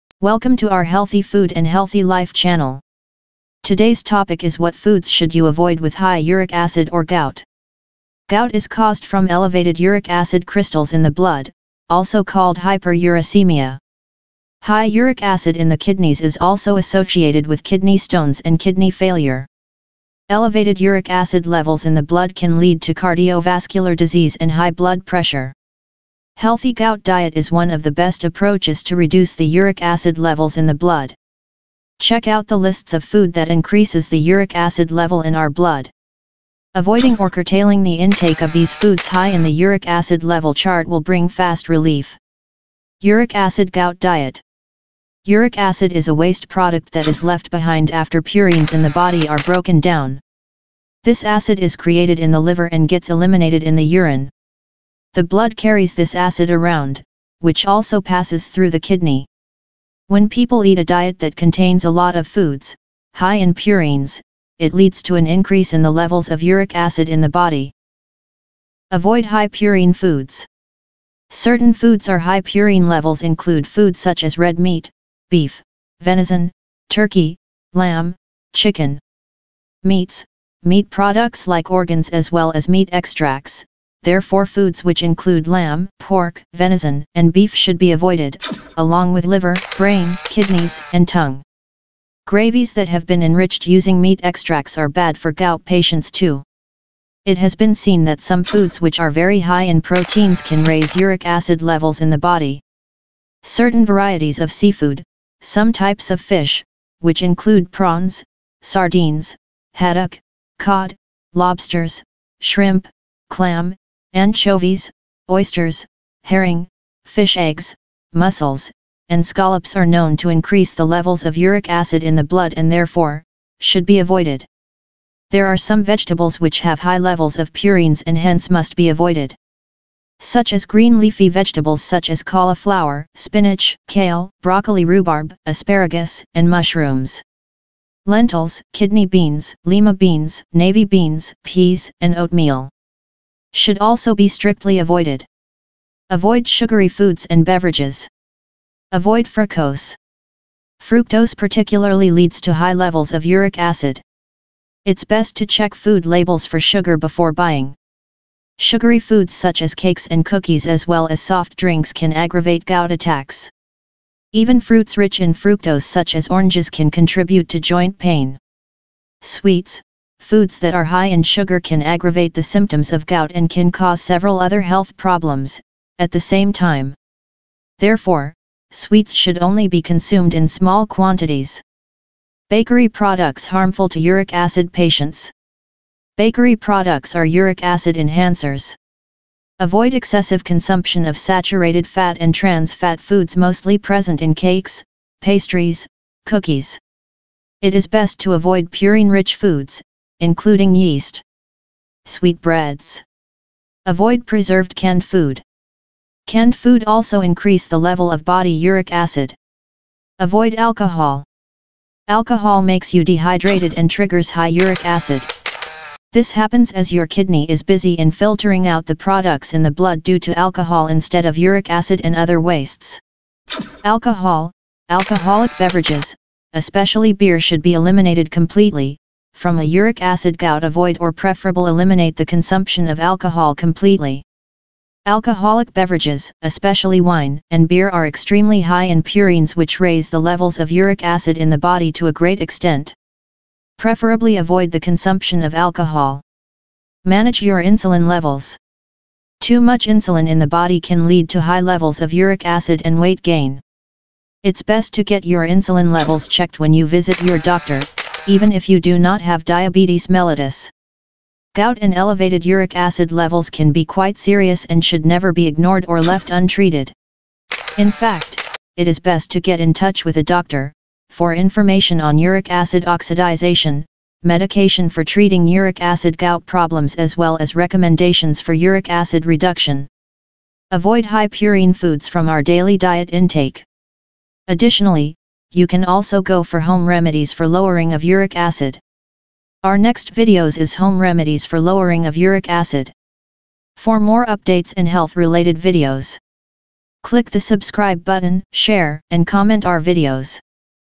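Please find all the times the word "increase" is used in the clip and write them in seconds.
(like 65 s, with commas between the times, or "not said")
33 s, 65 s, 120 s, 207 s.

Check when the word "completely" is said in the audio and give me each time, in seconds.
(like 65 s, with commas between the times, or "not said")
228 s, 233 s.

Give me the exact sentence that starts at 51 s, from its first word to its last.
This acid is created in the liver and gets eliminated in the urine.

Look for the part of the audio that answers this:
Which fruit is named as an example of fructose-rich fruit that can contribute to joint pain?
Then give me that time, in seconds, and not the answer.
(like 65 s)
166 s.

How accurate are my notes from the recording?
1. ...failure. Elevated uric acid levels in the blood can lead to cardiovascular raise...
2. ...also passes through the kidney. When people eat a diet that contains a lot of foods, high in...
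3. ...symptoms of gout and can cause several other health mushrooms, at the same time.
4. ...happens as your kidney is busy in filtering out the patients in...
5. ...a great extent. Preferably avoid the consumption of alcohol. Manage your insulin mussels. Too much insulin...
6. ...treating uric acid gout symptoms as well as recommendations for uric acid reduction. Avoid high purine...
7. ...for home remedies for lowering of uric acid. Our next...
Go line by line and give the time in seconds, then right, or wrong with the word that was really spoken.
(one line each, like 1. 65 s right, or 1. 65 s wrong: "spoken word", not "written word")
1. 18 s wrong: "disease", not "raise"
2. 57 s right
3. 172 s wrong: "problems", not "mushrooms"
4. 216 s wrong: "products", not "patients"
5. 242 s wrong: "levels", not "mussels"
6. 275 s wrong: "problems", not "symptoms"
7. 286 s right.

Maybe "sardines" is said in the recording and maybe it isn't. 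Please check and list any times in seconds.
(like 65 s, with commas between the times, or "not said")
108 s.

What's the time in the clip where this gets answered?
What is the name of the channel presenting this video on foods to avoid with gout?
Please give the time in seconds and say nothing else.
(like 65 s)
0 s.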